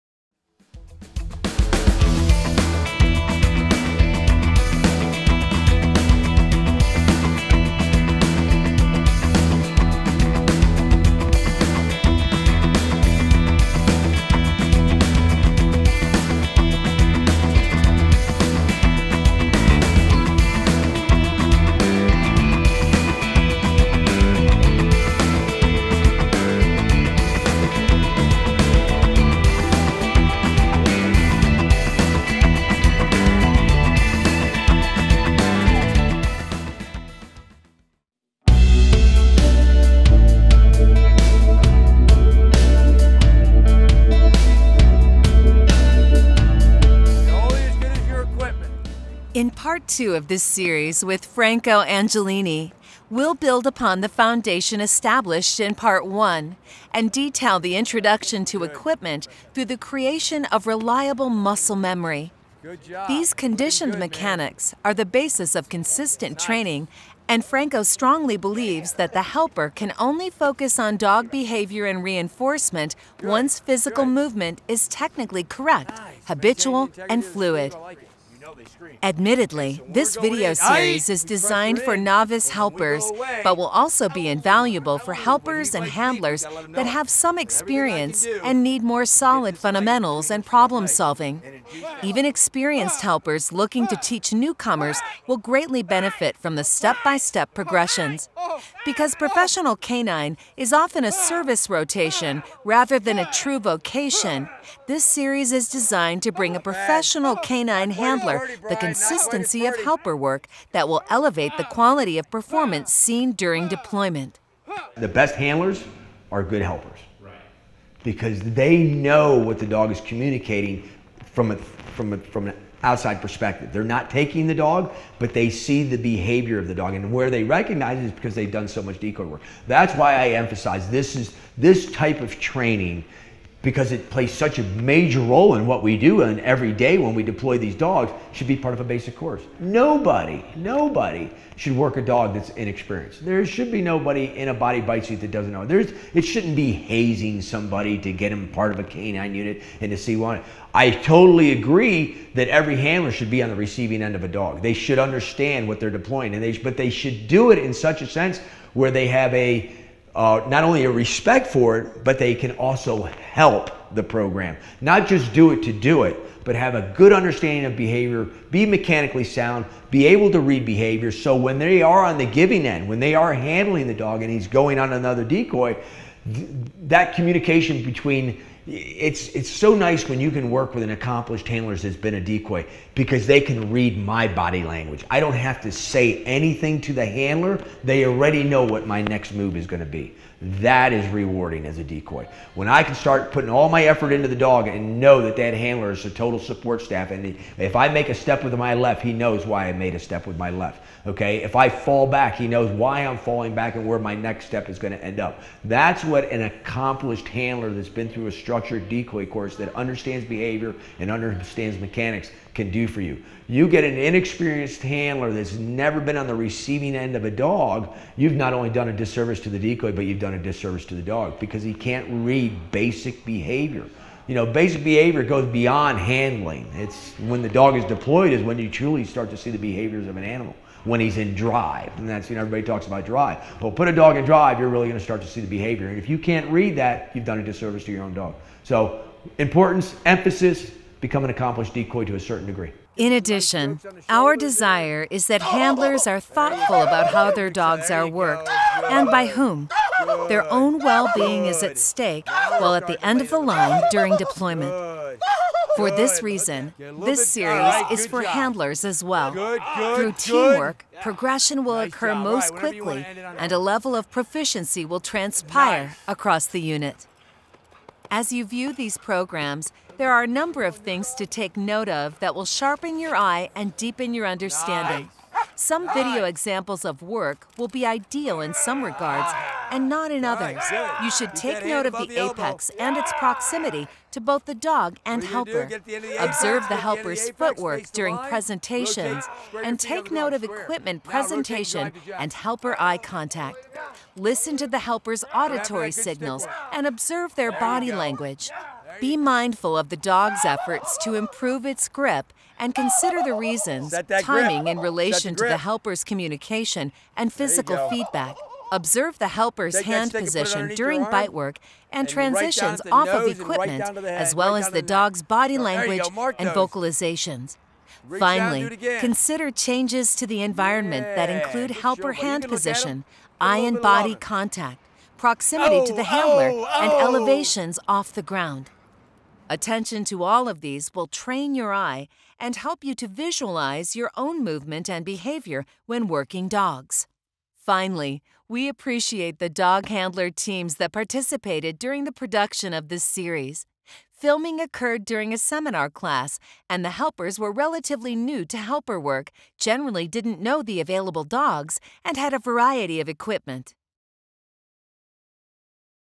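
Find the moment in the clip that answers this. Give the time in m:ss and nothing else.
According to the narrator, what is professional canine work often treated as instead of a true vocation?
1:41.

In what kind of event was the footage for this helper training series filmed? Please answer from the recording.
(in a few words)
A seminar class.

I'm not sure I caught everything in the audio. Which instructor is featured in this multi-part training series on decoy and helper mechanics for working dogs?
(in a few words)
Franco Angelini.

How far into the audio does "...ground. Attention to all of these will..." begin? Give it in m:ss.
5:28.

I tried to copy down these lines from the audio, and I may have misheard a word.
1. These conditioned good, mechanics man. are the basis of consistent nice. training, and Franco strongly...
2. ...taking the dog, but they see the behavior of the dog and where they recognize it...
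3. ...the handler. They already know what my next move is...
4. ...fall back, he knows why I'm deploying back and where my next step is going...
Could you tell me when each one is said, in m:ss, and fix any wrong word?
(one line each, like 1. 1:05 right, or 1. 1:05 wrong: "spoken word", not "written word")
1. 1:03 right
2. 2:04 right
3. 3:06 right
4. 3:21 wrong: "falling", not "deploying".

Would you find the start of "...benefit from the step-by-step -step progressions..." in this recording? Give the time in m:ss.
1:35.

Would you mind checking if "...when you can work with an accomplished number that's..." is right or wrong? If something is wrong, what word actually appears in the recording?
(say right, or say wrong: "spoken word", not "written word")
wrong: "handler", not "number".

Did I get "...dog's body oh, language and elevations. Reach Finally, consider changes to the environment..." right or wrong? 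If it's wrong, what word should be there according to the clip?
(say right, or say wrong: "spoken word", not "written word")
wrong: "vocalizations", not "elevations".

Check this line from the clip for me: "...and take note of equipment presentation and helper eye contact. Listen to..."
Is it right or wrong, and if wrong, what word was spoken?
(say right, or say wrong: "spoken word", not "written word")
right.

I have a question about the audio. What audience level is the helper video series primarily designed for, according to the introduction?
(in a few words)
Novice helpers.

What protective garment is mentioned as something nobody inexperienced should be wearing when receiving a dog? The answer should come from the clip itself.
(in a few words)
Body bite suit.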